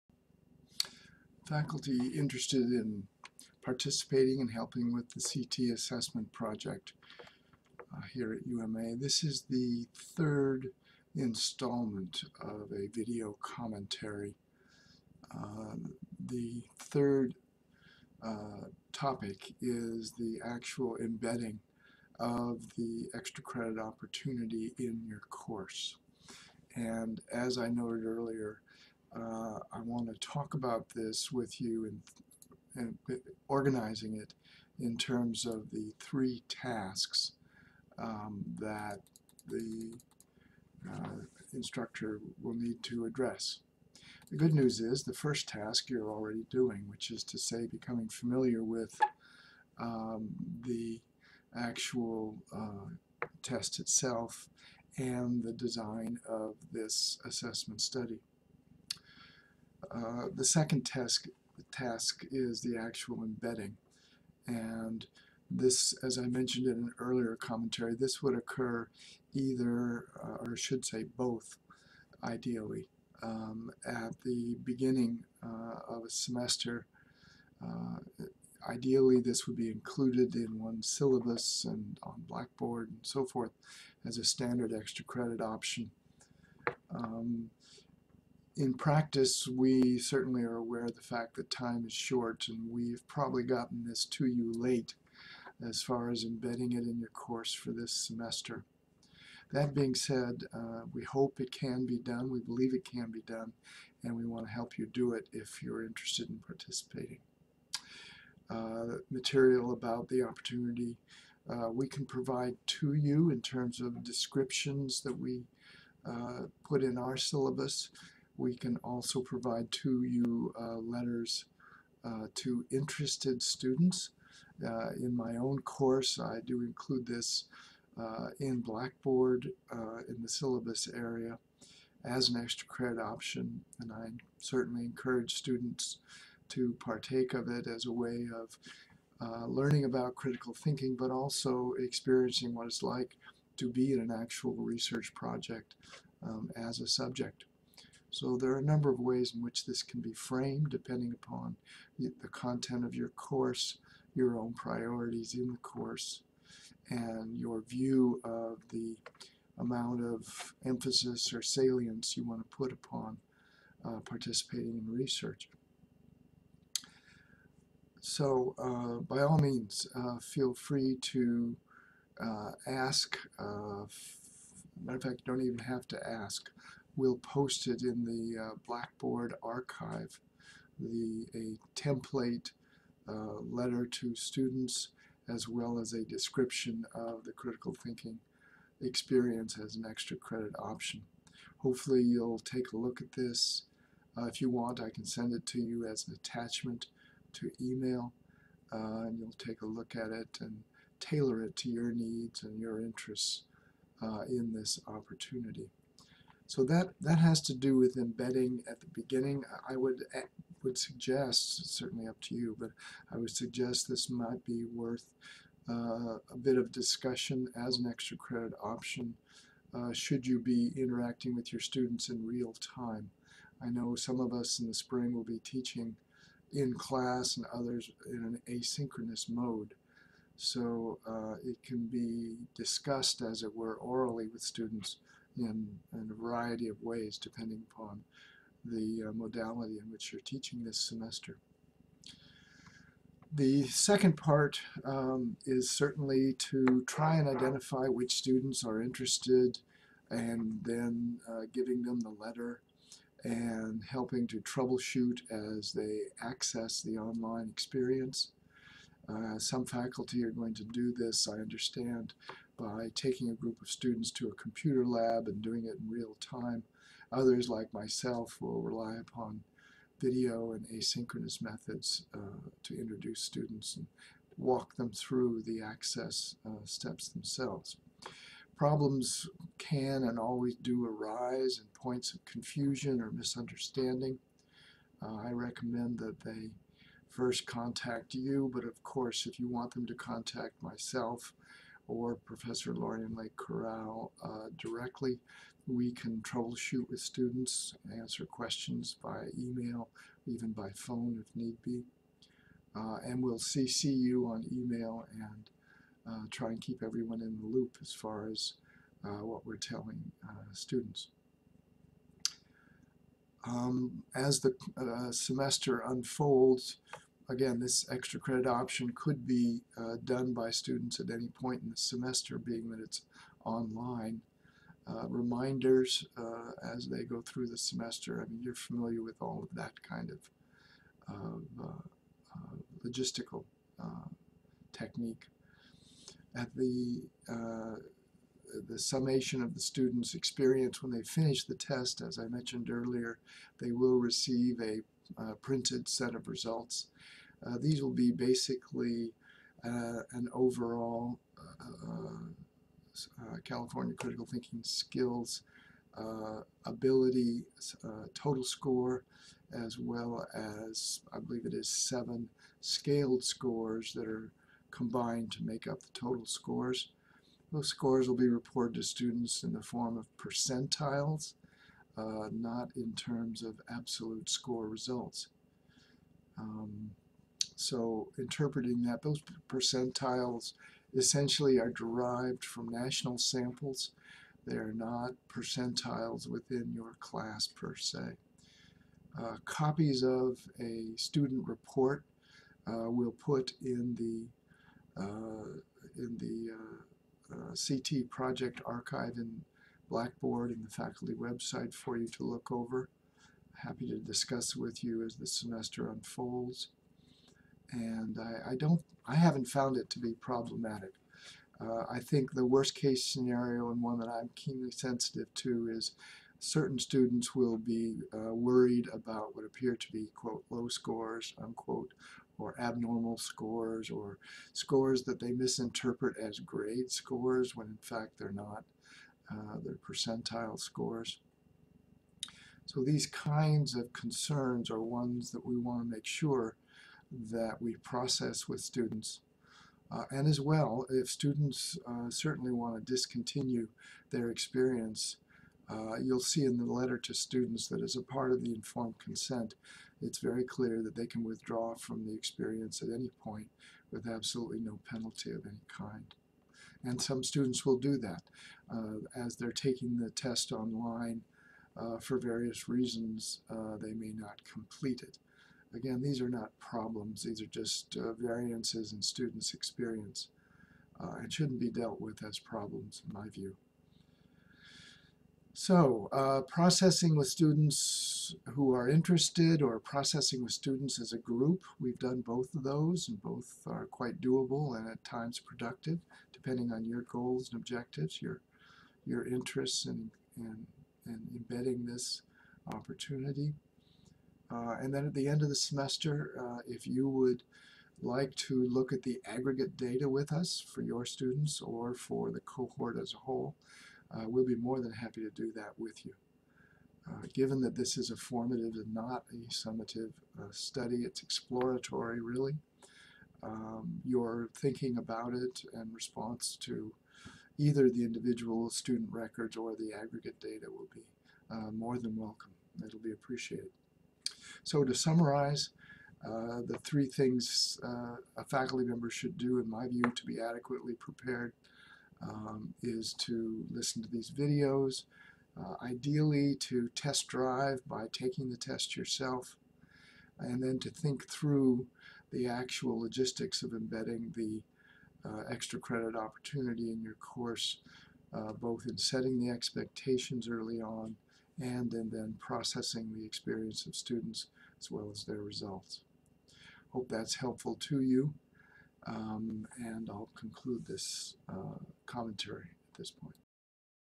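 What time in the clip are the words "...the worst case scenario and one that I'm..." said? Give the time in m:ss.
6:52.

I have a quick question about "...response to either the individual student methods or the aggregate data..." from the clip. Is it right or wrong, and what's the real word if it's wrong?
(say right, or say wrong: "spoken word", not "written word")
wrong: "records", not "methods".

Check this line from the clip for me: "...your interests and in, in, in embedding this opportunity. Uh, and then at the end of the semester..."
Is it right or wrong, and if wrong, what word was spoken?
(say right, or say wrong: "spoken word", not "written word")
right.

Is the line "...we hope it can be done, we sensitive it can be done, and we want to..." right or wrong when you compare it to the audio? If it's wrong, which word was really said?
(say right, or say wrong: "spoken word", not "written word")
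wrong: "believe", not "sensitive".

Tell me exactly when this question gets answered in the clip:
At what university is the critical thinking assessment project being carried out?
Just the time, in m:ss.
0:08.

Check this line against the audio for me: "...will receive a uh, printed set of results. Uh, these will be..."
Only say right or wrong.
right.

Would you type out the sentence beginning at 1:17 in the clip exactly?
Uh, ideally, this would be included in one syllabus and on Blackboard and so forth as a standard extra credit option.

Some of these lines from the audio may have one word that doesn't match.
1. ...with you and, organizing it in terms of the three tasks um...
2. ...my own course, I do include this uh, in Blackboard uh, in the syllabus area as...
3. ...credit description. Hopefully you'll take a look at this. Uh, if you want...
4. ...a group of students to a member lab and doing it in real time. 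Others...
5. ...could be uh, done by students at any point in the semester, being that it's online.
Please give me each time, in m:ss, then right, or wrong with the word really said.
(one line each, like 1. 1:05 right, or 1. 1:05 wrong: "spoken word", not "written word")
1. 0:31 right
2. 2:05 right
3. 3:10 wrong: "option", not "description"
4. 4:23 wrong: "computer", not "member"
5. 5:18 right.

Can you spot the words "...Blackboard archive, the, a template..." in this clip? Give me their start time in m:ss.
2:58.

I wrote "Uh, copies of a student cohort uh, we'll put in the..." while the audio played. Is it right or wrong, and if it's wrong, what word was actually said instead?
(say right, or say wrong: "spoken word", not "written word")
wrong: "report", not "cohort".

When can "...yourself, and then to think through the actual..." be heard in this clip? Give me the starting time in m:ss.
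8:58.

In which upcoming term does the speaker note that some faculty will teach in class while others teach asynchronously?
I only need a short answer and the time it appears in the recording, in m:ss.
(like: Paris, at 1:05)
spring, at 3:44.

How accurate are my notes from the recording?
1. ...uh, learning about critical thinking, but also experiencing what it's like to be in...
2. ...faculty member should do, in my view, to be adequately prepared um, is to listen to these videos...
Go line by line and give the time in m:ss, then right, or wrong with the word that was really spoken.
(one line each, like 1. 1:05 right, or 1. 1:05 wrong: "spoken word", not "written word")
1. 2:19 right
2. 8:48 right.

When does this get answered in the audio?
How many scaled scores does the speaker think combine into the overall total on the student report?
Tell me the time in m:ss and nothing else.
6:01.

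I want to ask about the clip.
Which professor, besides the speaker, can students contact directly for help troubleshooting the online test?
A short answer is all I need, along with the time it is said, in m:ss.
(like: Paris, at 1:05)
Lorian Lake Corral, at 4:52.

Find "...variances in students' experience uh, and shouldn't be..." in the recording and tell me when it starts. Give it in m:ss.
7:48.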